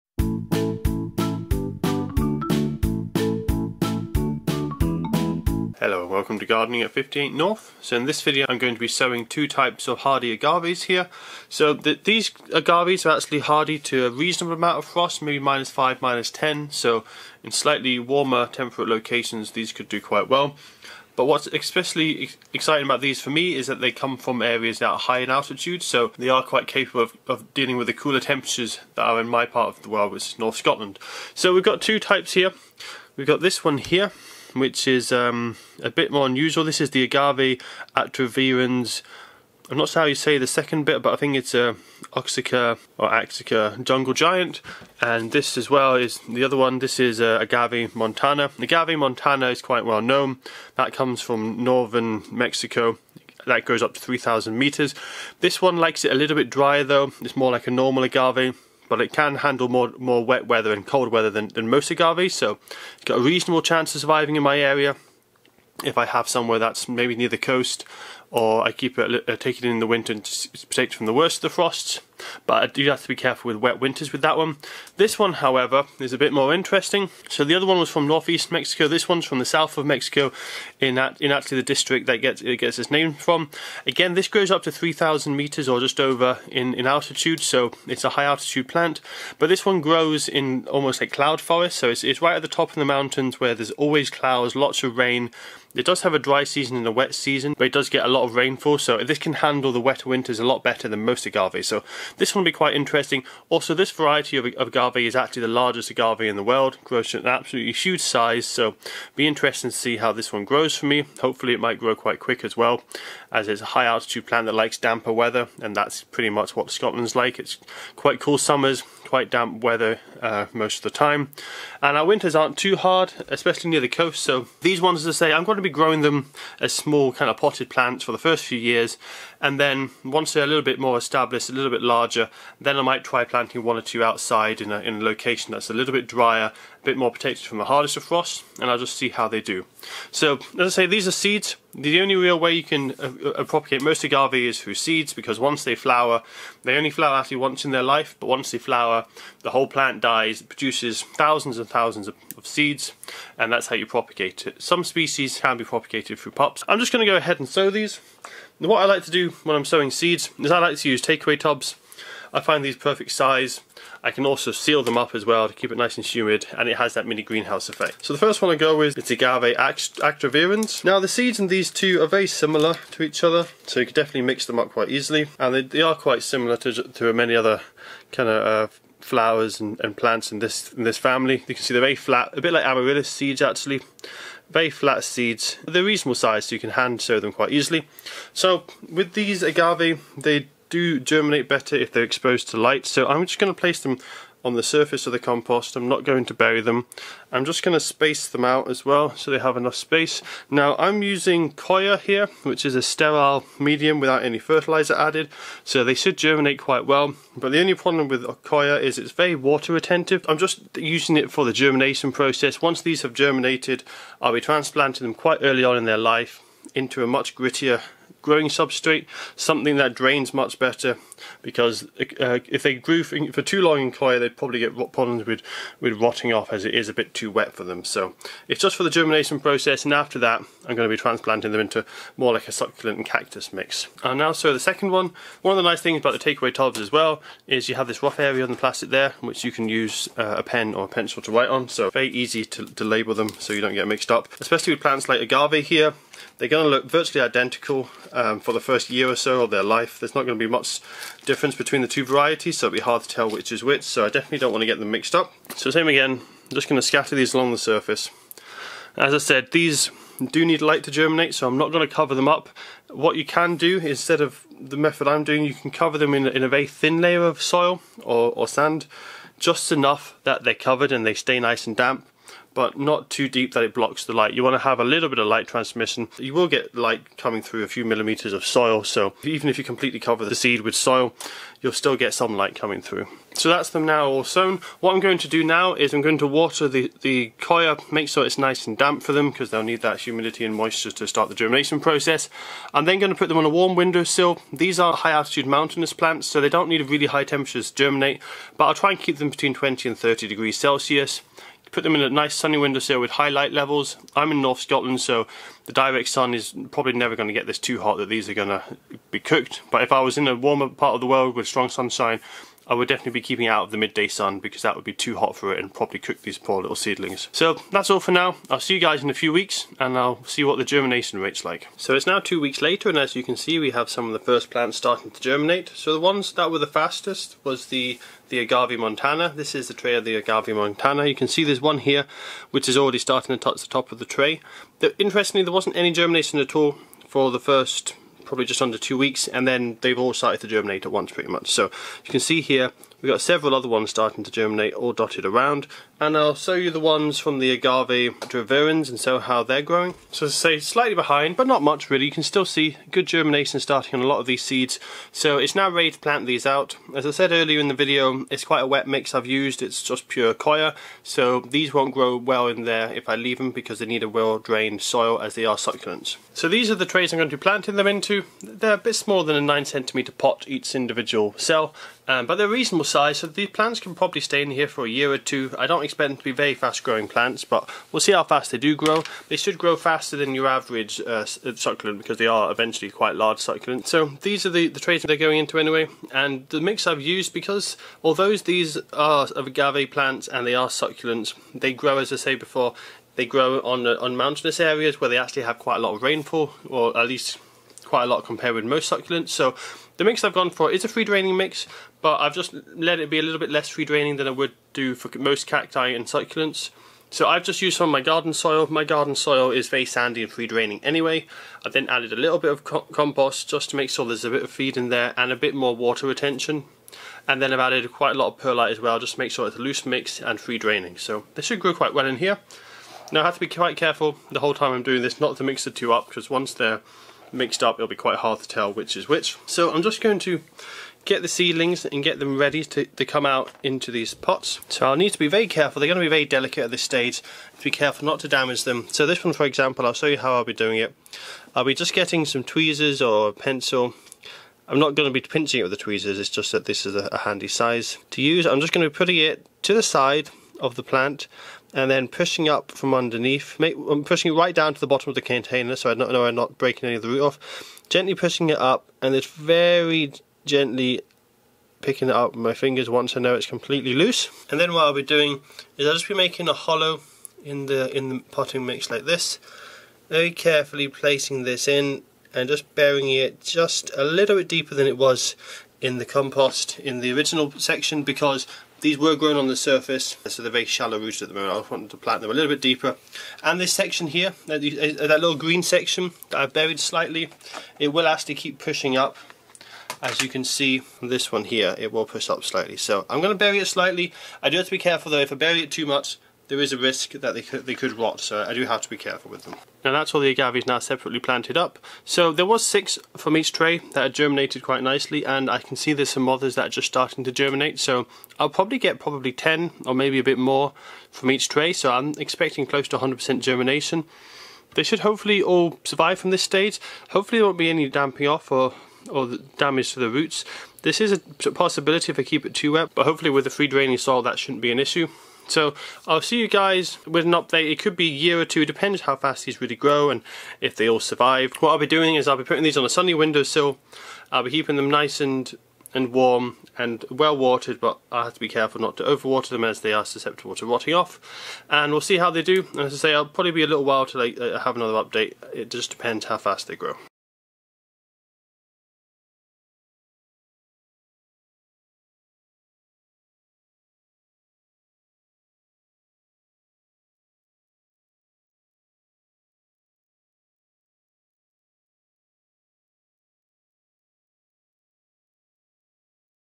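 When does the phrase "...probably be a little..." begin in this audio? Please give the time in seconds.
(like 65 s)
543 s.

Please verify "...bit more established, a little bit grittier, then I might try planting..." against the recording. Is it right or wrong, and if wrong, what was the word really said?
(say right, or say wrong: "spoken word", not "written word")
wrong: "larger", not "grittier".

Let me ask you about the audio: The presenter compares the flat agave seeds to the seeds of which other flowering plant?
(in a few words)
amaryllis.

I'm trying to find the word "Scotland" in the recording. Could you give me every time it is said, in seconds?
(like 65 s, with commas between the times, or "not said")
30 s, 116 s, 304 s.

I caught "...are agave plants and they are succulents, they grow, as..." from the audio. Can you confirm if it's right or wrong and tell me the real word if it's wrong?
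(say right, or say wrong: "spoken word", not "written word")
right.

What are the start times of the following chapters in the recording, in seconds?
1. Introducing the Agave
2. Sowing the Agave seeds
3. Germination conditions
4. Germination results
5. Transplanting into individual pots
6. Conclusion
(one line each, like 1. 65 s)
1. 12 s
2. 156 s
3. 283 s
4. 321 s
5. 365 s
6. 515 s.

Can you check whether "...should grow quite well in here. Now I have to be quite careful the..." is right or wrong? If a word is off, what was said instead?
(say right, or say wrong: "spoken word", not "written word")
right.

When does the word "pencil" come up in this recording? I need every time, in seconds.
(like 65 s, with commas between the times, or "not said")
240 s, 443 s.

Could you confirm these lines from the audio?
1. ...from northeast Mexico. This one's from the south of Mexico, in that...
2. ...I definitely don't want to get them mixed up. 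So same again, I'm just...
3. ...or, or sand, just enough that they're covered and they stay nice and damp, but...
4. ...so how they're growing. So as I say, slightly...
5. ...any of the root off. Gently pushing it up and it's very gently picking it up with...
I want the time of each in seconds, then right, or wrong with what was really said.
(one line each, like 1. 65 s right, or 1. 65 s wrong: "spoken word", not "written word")
1. 77 s right
2. 254 s right
3. 268 s right
4. 348 s right
5. 456 s right.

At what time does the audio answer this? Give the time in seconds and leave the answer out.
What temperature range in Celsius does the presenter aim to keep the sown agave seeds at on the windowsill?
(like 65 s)
299 s.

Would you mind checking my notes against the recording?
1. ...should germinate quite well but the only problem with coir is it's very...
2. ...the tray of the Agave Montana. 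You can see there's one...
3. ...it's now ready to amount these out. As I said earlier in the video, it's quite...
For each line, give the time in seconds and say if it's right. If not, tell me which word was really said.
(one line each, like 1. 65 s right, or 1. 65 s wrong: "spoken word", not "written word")
1. 205 s right
2. 329 s right
3. 355 s wrong: "plant", not "amount".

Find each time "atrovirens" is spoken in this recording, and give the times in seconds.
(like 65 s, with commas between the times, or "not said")
37 s, 348 s.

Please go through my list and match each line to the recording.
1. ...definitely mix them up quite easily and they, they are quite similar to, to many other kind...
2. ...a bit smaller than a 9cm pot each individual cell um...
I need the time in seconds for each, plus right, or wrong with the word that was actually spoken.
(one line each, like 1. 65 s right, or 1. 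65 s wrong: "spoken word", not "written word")
1. 173 s right
2. 368 s right.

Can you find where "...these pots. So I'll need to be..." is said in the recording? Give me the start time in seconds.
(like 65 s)
433 s.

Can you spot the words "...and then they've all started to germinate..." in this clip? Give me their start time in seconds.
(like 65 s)
339 s.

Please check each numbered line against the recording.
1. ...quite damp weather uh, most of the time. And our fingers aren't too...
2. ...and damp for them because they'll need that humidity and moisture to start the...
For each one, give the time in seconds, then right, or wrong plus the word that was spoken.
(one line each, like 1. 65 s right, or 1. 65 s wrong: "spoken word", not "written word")
1. 119 s wrong: "winters", not "fingers"
2. 288 s right.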